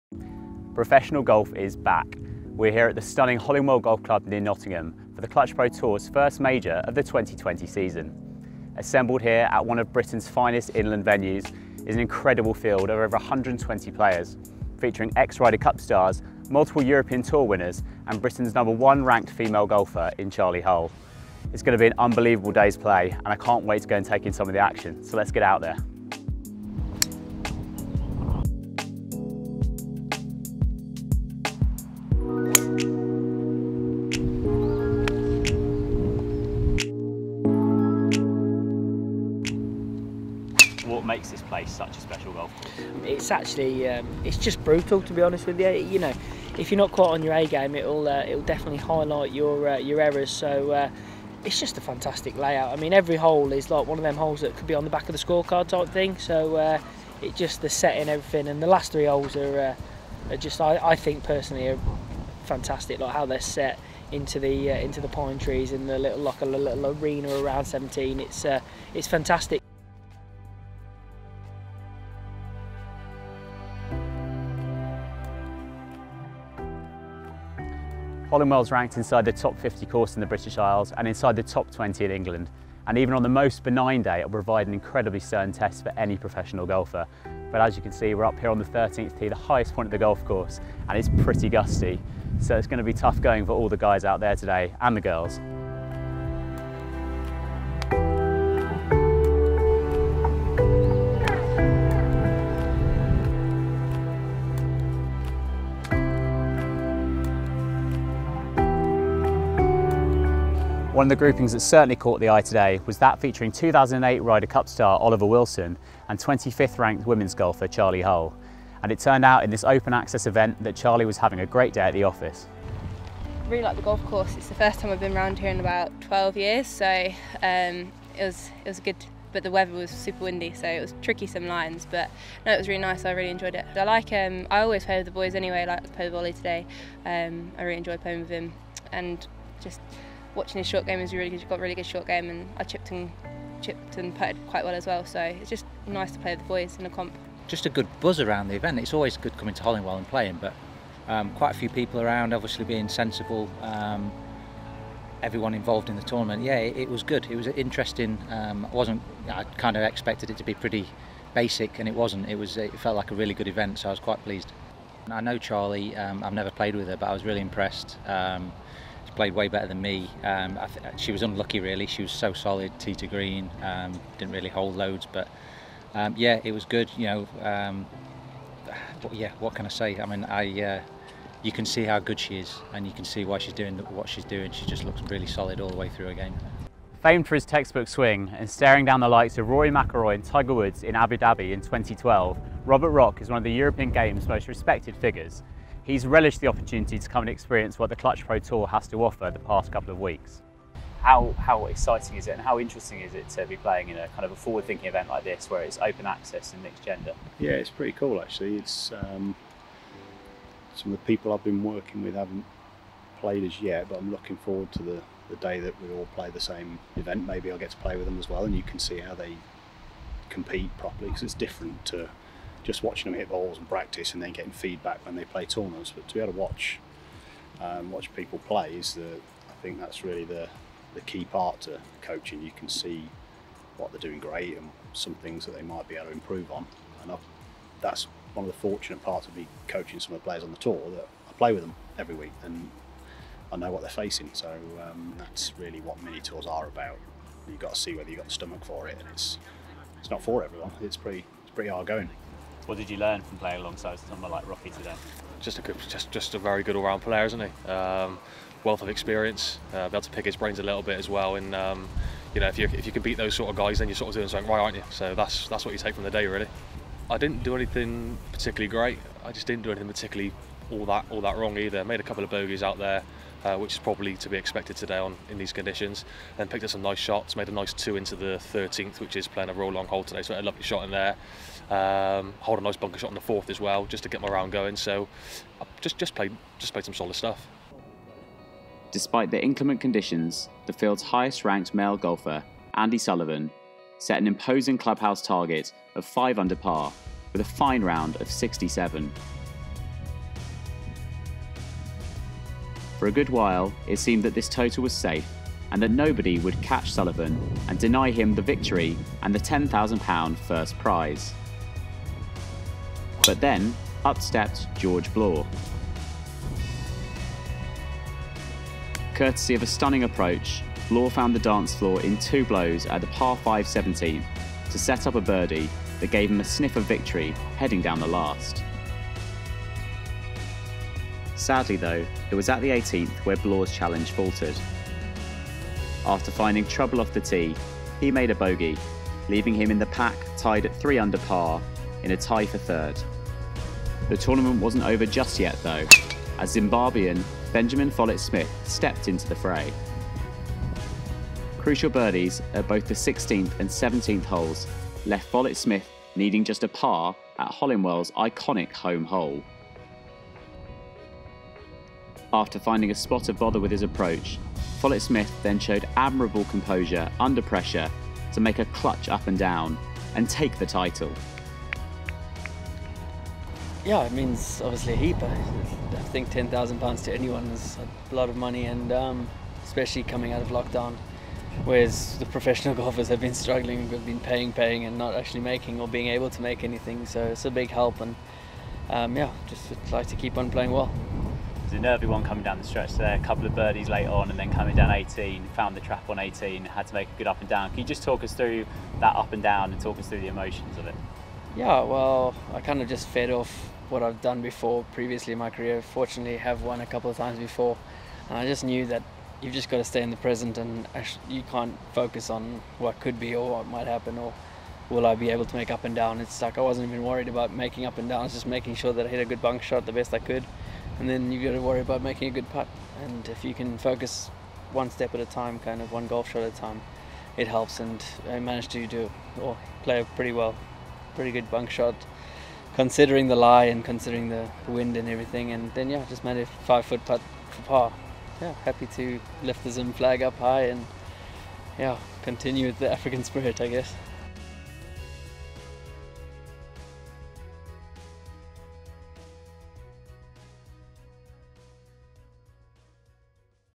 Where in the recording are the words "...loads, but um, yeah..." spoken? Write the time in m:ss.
2:54.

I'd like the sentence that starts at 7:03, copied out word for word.
And if you can focus one step at a time, kind of one golf shot at a time, it helps.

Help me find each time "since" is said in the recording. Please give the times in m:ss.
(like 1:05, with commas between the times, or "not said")
not said.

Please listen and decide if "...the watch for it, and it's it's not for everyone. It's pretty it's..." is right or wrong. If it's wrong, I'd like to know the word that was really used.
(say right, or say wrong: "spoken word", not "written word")
wrong: "stomach", not "watch".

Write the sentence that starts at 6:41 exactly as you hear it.
Yeah, well, I kind of just fed off what I've done before previously in my career.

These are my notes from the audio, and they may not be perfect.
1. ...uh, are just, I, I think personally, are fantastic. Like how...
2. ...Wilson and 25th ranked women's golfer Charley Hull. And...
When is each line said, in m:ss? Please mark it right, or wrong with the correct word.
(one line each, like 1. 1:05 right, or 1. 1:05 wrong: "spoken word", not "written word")
1. 1:00 right
2. 1:55 right.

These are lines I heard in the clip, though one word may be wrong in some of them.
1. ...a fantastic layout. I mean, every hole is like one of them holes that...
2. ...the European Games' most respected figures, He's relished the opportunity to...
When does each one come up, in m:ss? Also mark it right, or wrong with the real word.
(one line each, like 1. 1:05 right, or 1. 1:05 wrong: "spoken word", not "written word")
1. 0:51 right
2. 3:13 right.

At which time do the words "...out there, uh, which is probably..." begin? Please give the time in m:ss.
4:32.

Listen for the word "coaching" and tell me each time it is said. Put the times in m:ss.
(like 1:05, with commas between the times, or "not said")
3:52, 3:59.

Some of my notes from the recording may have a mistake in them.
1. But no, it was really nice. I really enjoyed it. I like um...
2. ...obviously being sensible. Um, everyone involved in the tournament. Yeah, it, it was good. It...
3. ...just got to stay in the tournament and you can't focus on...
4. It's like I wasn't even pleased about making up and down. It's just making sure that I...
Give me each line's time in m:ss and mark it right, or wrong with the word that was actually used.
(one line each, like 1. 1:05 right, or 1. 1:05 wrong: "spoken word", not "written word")
1. 2:11 right
2. 2:32 right
3. 6:49 wrong: "present", not "tournament"
4. 6:56 wrong: "worried", not "pleased".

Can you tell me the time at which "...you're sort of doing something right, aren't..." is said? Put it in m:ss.
4:23.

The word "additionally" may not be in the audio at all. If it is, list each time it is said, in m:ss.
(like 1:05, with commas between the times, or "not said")
not said.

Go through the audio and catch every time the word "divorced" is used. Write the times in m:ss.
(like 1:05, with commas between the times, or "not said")
not said.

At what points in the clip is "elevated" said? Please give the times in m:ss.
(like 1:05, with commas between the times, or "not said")
not said.